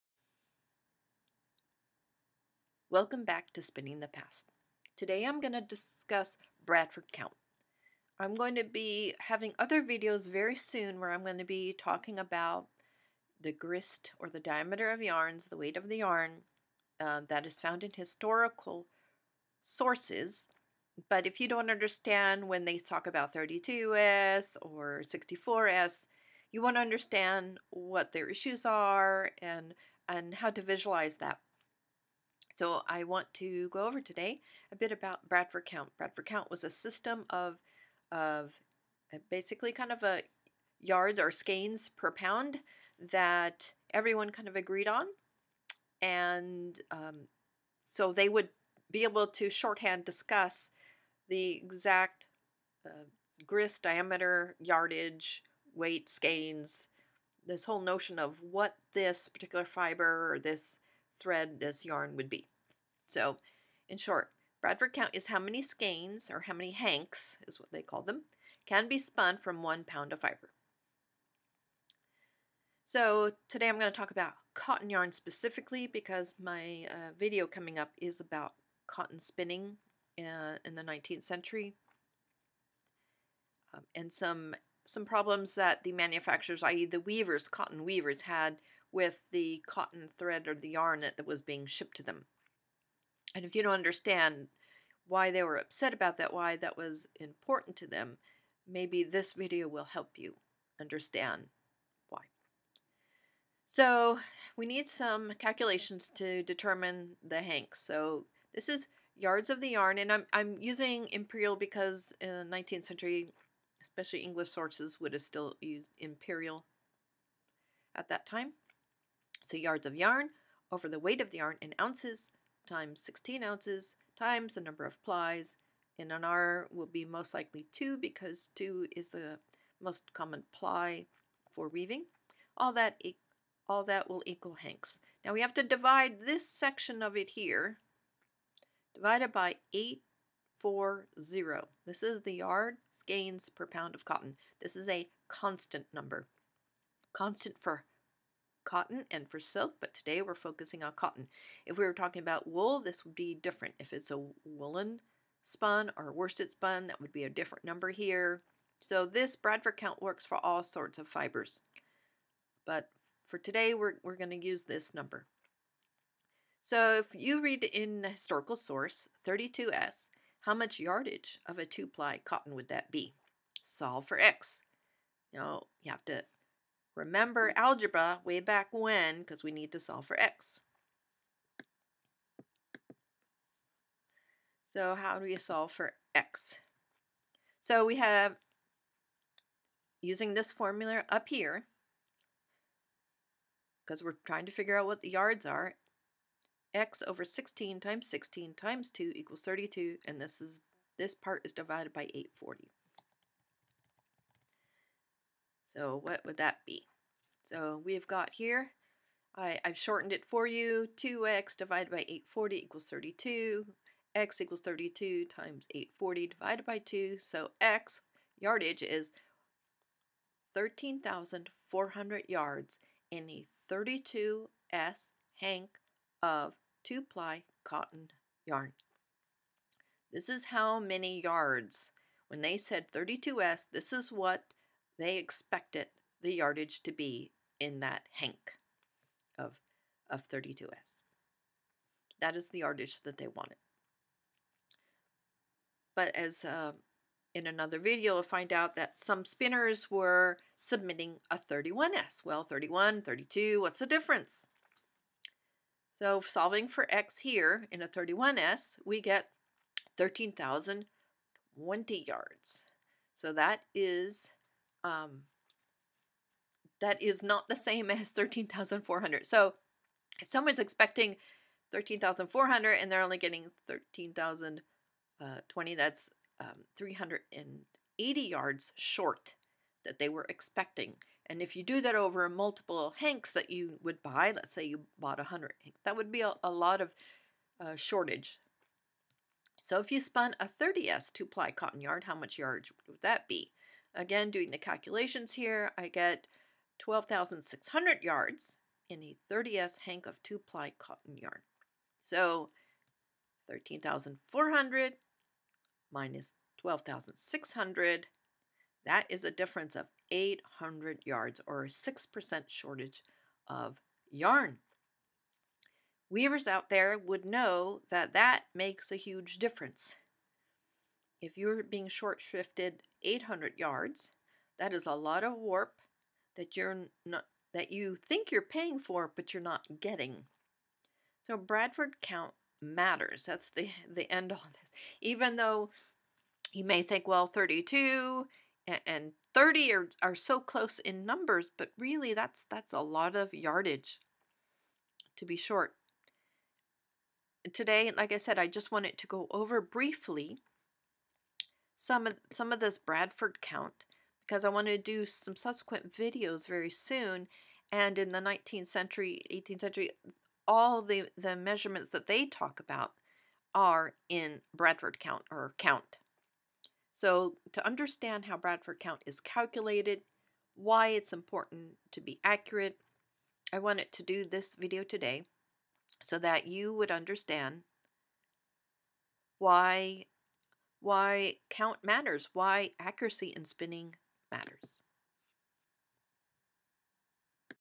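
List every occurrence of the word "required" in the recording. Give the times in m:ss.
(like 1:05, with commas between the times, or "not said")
not said.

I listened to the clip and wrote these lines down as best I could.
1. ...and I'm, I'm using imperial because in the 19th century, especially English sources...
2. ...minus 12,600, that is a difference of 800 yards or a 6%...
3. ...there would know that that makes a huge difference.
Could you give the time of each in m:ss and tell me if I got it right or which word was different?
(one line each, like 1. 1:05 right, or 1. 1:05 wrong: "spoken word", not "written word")
1. 1:49 right
2. 5:05 right
3. 5:16 right.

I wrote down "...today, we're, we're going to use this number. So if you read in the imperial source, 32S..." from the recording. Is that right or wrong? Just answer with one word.
wrong.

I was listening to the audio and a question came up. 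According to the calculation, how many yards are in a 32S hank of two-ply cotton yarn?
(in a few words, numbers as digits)
13,400 yards.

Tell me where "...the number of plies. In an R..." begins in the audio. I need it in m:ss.
2:04.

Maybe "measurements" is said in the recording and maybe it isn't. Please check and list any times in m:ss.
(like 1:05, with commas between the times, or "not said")
6:01.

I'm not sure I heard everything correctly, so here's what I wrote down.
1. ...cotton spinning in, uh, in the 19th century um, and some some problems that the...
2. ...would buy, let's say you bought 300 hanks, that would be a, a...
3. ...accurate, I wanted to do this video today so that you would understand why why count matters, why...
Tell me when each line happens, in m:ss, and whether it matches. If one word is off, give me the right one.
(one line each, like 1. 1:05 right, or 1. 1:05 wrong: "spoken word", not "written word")
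1. 1:18 right
2. 4:43 wrong: "100", not "300"
3. 6:12 right.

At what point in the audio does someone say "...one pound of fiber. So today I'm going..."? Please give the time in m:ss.
1:09.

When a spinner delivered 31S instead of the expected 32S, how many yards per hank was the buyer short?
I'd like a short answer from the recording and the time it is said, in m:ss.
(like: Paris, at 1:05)
380 yards, at 4:36.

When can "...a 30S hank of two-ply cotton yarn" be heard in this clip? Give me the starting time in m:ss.
4:59.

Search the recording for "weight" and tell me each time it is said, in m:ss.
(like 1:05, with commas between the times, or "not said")
0:15, 0:55, 2:00.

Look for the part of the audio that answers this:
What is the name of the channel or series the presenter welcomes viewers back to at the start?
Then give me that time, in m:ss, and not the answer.
0:03.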